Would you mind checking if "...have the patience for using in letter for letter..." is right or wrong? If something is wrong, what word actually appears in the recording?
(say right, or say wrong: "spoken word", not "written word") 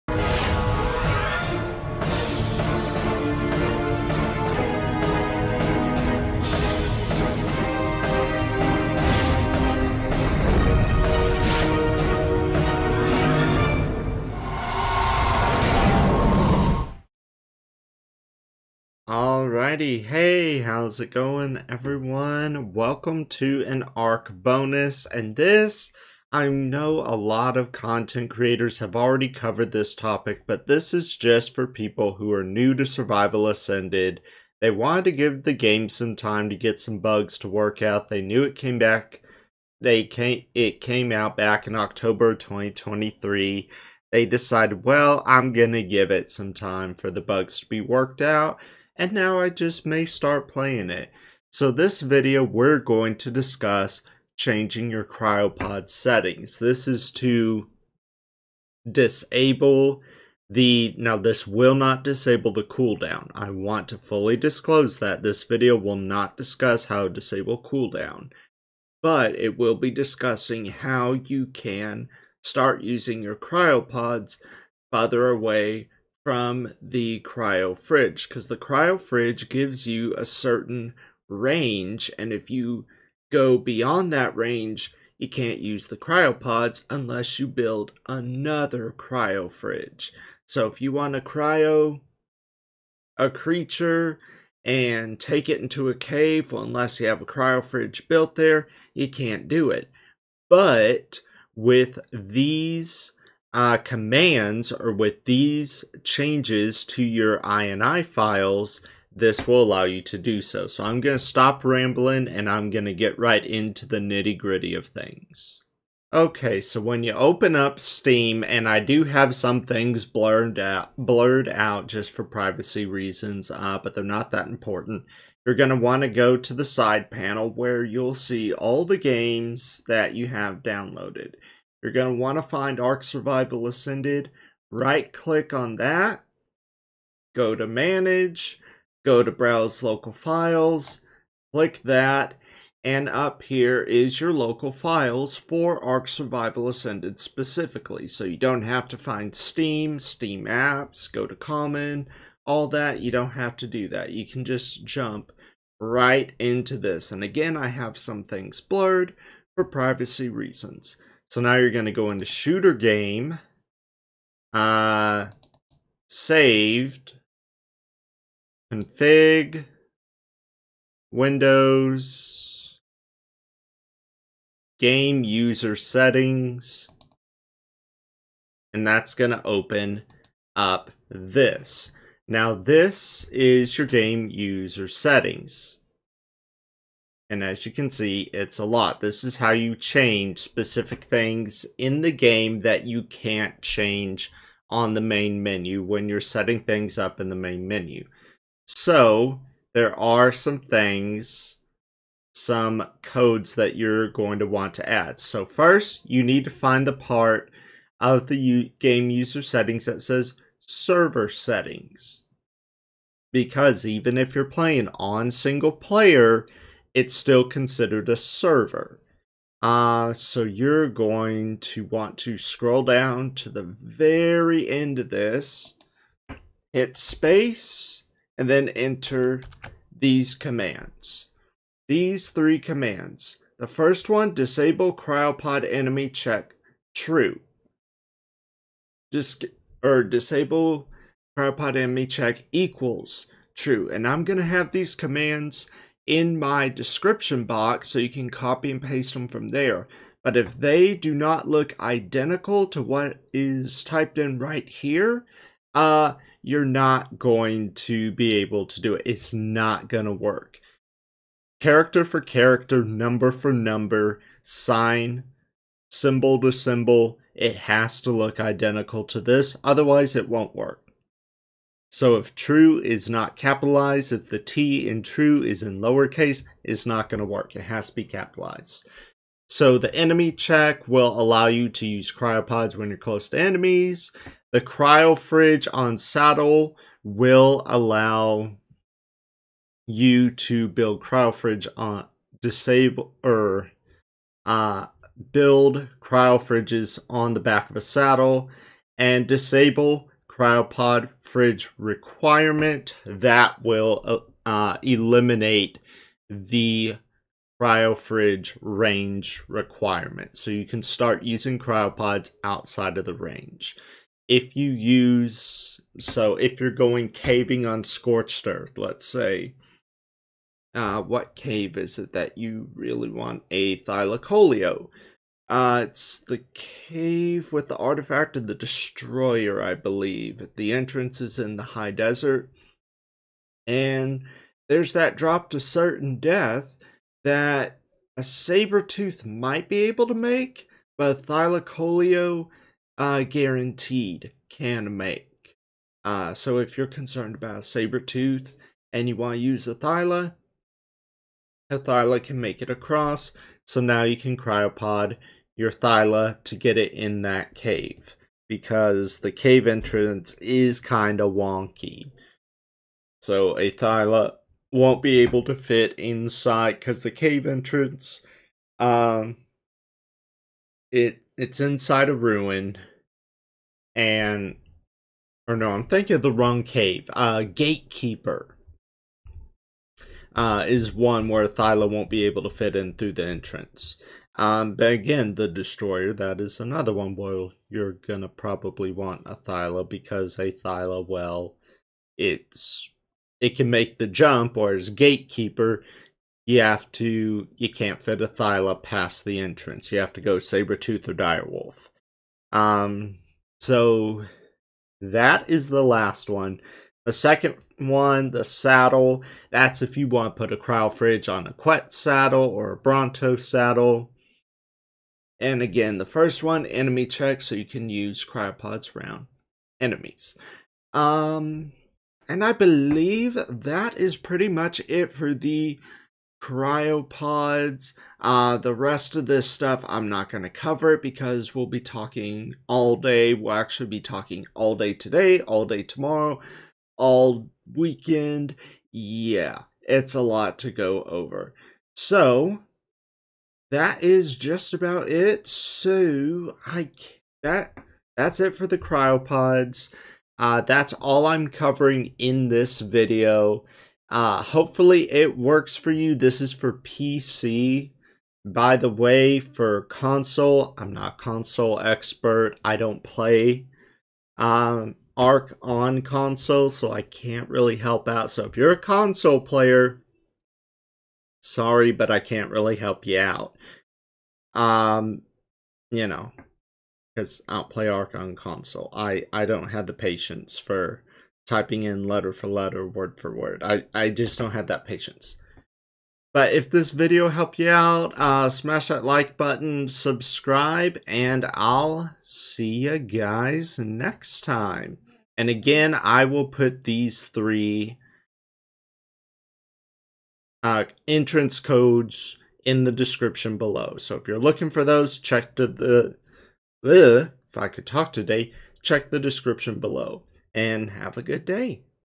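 wrong: "typing", not "using".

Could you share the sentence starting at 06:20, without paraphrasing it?
Uh, is one where Thyla won't be able to fit in through the entrance.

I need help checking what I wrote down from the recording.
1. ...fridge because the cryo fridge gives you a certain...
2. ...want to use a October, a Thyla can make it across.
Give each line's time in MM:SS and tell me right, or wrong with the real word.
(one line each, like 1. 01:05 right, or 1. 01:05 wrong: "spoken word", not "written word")
1. 01:17 right
2. 05:49 wrong: "Thyla", not "October".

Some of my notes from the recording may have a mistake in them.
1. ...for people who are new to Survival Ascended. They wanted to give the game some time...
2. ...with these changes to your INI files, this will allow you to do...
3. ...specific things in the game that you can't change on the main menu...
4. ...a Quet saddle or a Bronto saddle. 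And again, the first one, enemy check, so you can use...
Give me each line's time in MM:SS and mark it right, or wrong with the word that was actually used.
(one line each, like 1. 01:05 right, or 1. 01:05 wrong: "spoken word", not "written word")
1. 00:31 right
2. 01:44 right
3. 03:10 right
4. 06:51 right.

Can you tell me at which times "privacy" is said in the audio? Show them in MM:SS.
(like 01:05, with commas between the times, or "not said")
02:02, 02:39.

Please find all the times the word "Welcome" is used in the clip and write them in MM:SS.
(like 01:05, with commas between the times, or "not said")
00:22.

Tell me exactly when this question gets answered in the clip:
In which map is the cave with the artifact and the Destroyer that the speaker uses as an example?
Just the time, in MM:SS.
05:17.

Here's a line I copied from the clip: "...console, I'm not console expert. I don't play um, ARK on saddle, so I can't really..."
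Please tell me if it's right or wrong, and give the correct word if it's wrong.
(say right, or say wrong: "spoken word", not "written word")
wrong: "console", not "saddle".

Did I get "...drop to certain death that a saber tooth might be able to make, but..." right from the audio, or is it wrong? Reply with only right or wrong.
right.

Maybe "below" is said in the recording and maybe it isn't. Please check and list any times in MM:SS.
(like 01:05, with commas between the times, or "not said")
08:23, 08:29.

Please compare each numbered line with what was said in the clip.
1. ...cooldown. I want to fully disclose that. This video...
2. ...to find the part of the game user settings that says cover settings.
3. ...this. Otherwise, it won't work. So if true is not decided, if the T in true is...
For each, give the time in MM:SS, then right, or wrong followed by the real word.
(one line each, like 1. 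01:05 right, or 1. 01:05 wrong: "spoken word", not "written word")
1. 01:02 right
2. 03:26 wrong: "server", not "cover"
3. 04:29 wrong: "capitalized", not "decided".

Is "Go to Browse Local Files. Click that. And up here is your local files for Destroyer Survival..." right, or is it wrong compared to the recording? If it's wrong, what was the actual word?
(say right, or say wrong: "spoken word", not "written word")
wrong: "ARK", not "Destroyer".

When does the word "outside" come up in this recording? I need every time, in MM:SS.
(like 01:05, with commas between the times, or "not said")
05:12.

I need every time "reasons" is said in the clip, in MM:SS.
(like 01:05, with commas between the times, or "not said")
02:02, 02:40.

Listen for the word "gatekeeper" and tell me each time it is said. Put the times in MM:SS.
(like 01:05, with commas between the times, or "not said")
06:17, 06:34.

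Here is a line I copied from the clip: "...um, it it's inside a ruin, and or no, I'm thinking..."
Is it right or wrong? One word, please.
right.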